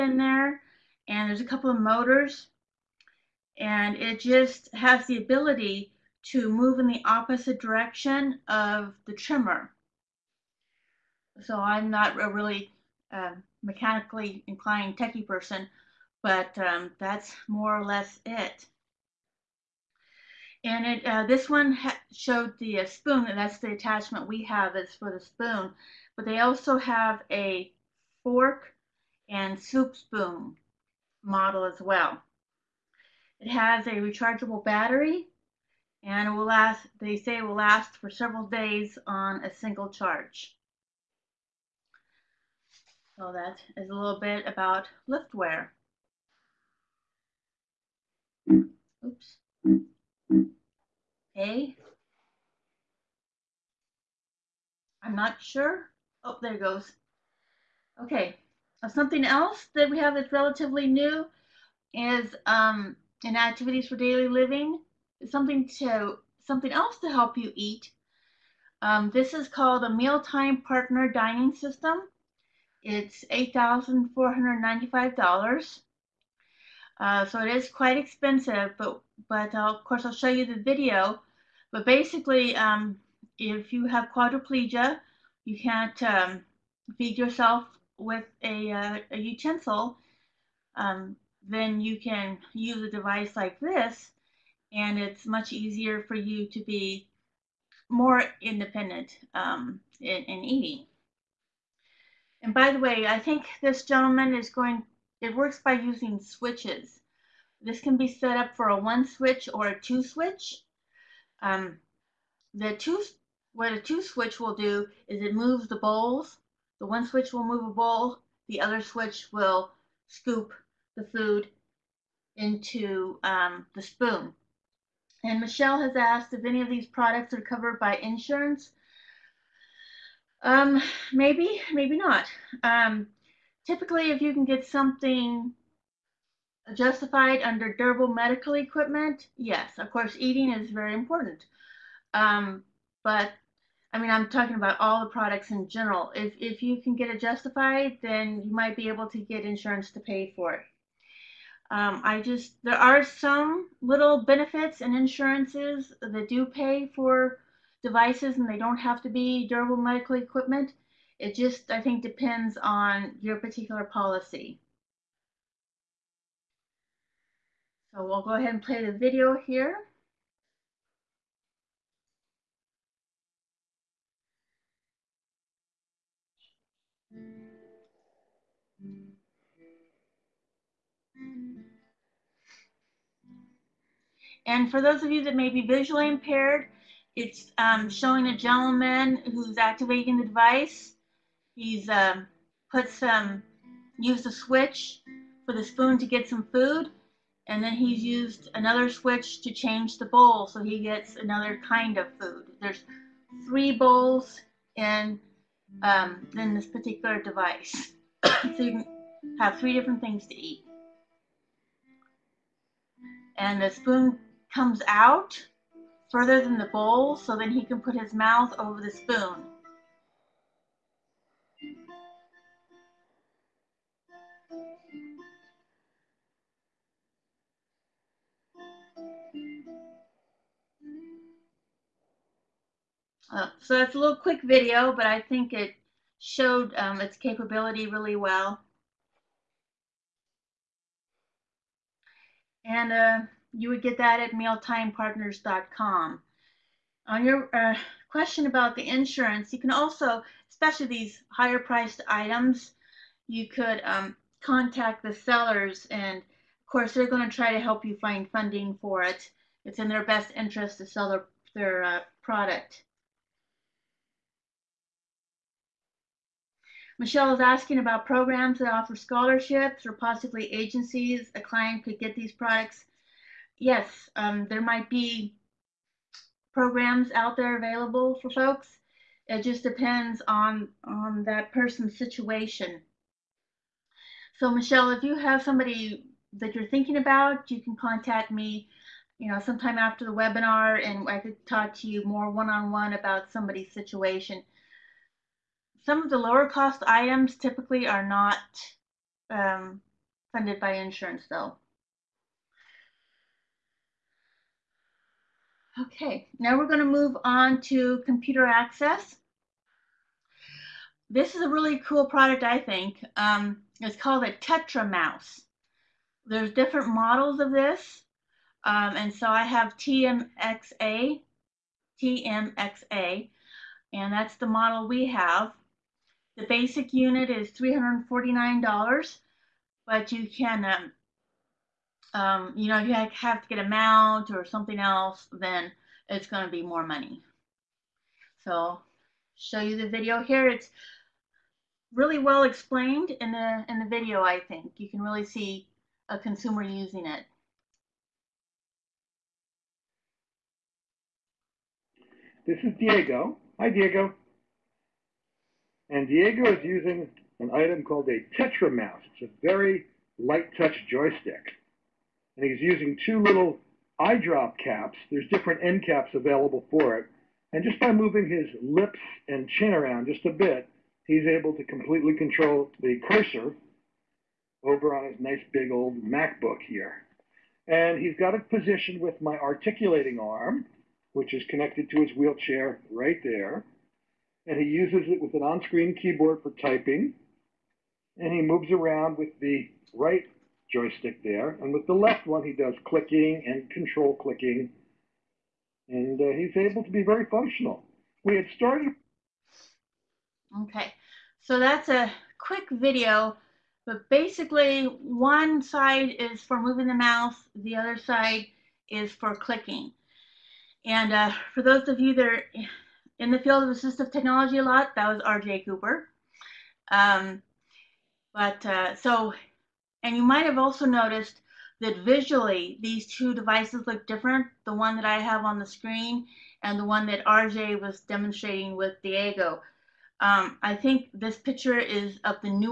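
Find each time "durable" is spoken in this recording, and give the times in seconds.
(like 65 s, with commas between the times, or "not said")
137 s, 159 s.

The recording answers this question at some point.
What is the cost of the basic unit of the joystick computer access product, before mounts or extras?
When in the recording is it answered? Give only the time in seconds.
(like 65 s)
327 s.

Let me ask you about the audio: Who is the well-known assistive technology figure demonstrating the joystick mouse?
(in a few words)
R.J. Cooper.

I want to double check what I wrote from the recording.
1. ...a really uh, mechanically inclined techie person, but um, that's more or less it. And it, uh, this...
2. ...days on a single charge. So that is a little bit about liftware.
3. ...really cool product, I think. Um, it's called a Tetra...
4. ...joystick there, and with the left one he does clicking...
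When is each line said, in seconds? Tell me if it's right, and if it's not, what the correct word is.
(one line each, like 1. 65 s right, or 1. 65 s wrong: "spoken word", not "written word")
1. 12 s right
2. 38 s right
3. 311 s right
4. 390 s right.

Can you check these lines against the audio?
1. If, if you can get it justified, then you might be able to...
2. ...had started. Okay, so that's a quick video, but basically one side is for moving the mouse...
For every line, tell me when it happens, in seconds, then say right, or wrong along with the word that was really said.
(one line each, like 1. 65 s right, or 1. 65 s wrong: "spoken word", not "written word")
1. 146 s right
2. 398 s right.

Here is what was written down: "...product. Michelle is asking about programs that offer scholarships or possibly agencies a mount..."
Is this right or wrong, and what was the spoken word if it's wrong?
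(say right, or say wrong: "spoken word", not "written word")
wrong: "client", not "mount".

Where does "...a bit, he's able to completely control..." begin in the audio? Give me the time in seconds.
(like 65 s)
370 s.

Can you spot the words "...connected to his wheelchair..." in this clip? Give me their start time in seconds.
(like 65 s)
381 s.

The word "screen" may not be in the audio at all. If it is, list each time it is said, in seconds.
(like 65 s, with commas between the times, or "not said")
385 s, 425 s.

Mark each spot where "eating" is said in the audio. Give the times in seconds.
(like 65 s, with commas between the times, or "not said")
100 s, 140 s.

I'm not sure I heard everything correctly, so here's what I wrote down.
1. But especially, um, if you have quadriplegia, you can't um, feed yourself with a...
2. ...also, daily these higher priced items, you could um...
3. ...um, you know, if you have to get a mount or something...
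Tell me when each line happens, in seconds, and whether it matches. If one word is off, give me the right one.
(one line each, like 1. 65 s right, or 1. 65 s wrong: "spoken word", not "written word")
1. 81 s wrong: "basically", not "especially"
2. 249 s wrong: "especially", not "daily"
3. 332 s right.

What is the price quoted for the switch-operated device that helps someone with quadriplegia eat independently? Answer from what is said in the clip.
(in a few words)
$8,495.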